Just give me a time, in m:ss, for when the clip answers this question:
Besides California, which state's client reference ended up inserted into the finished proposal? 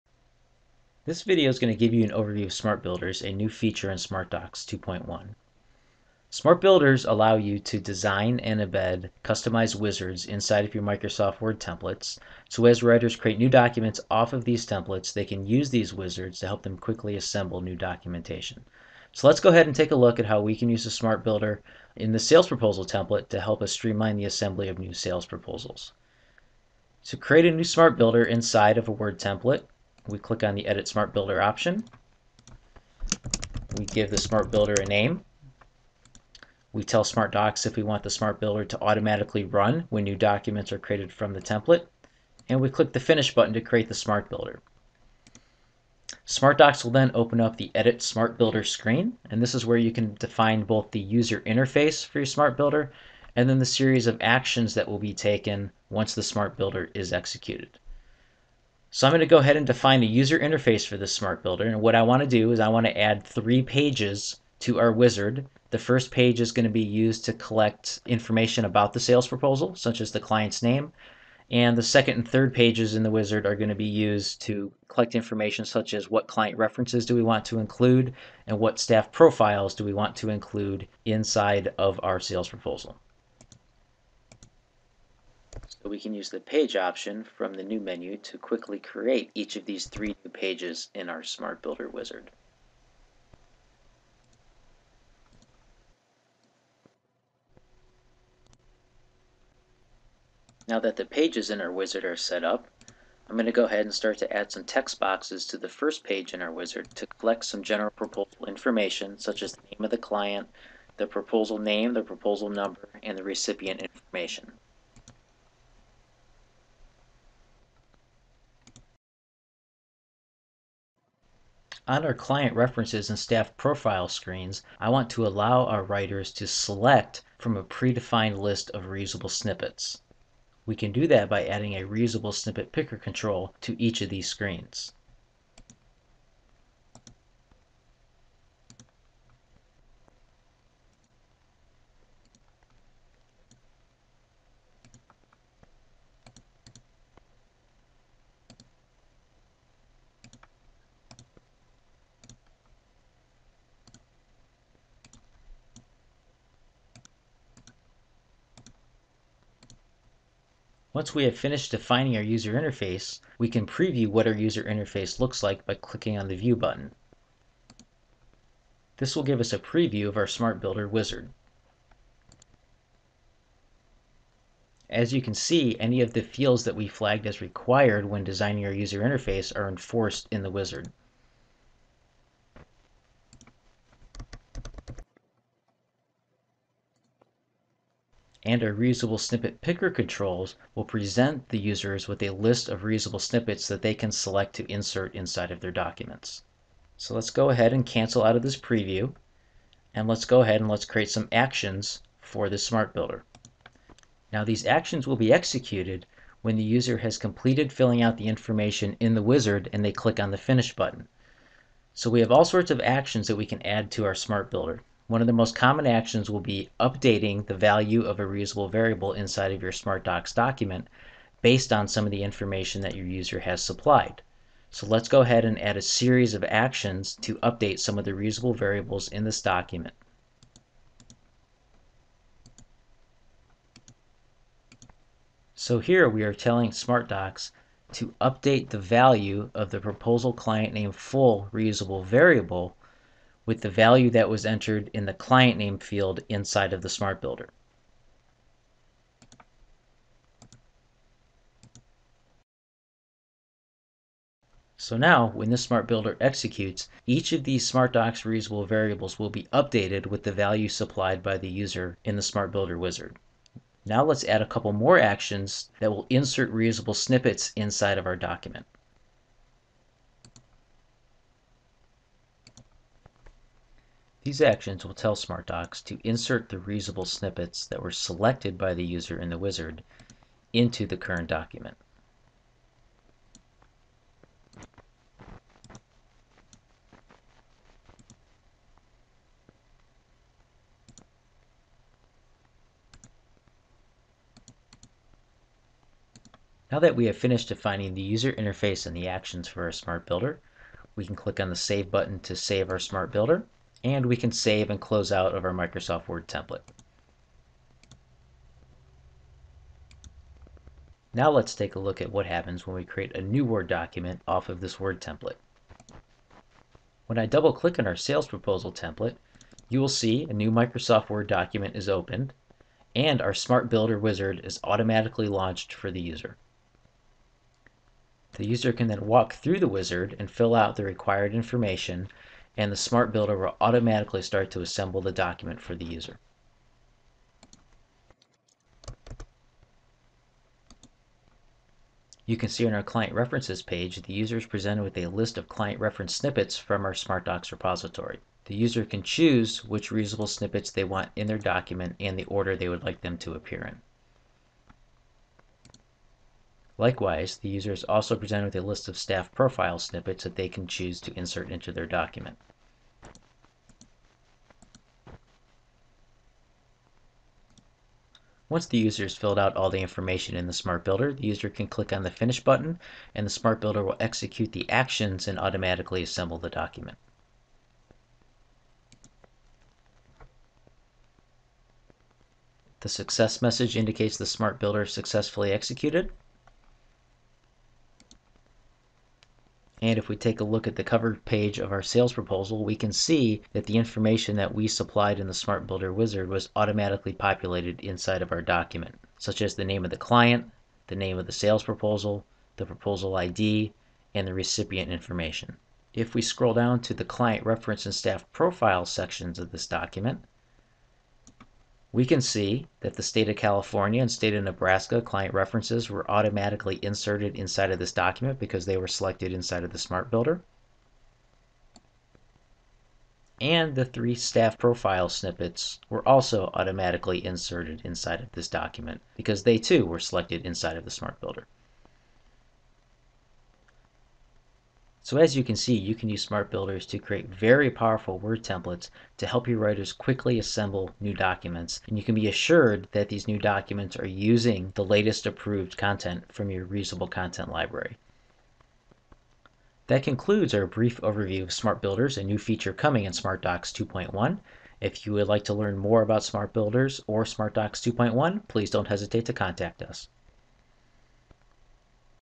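6:54.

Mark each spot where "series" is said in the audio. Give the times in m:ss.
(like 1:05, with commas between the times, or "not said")
0:53, 3:45.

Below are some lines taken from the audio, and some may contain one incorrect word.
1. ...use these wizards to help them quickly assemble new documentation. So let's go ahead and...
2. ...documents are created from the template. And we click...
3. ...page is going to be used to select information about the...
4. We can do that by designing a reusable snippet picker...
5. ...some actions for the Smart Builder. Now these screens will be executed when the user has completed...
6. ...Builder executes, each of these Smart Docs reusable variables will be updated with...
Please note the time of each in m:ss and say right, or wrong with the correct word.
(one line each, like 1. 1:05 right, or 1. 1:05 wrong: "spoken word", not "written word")
1. 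0:15 right
2. 0:40 right
3. 1:06 wrong: "collect", not "select"
4. 2:10 wrong: "adding", not "designing"
5. 3:21 wrong: "actions", not "screens"
6. 4:15 right.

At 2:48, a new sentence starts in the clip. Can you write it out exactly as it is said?
This will give us a preview of our Smart Builder wizard.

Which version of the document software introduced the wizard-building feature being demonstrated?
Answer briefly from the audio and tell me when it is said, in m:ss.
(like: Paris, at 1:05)
SmartDocs 2.1, at 0:03.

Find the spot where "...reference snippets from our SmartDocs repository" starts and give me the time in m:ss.
5:45.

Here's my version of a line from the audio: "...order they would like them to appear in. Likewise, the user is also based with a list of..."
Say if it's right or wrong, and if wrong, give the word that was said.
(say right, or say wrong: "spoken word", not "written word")
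wrong: "presented", not "based".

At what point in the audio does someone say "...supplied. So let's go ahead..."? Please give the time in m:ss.
3:43.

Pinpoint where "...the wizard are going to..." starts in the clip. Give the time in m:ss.
1:13.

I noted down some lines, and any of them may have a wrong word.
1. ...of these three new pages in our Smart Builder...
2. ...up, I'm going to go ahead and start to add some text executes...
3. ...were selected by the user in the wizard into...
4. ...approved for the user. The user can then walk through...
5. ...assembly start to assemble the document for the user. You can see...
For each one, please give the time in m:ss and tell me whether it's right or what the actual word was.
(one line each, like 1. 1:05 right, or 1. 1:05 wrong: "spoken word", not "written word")
1. 1:29 right
2. 1:42 wrong: "boxes", not "executes"
3. 4:37 right
4. 5:25 wrong: "launched", not "approved"
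5. 5:33 wrong: "automatically", not "assembly".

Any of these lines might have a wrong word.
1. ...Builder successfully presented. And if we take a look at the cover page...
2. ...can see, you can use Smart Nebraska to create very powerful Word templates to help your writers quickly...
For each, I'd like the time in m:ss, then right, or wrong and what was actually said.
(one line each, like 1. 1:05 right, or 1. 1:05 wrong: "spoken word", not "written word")
1. 6:24 wrong: "executed", not "presented"
2. 7:15 wrong: "Builders", not "Nebraska".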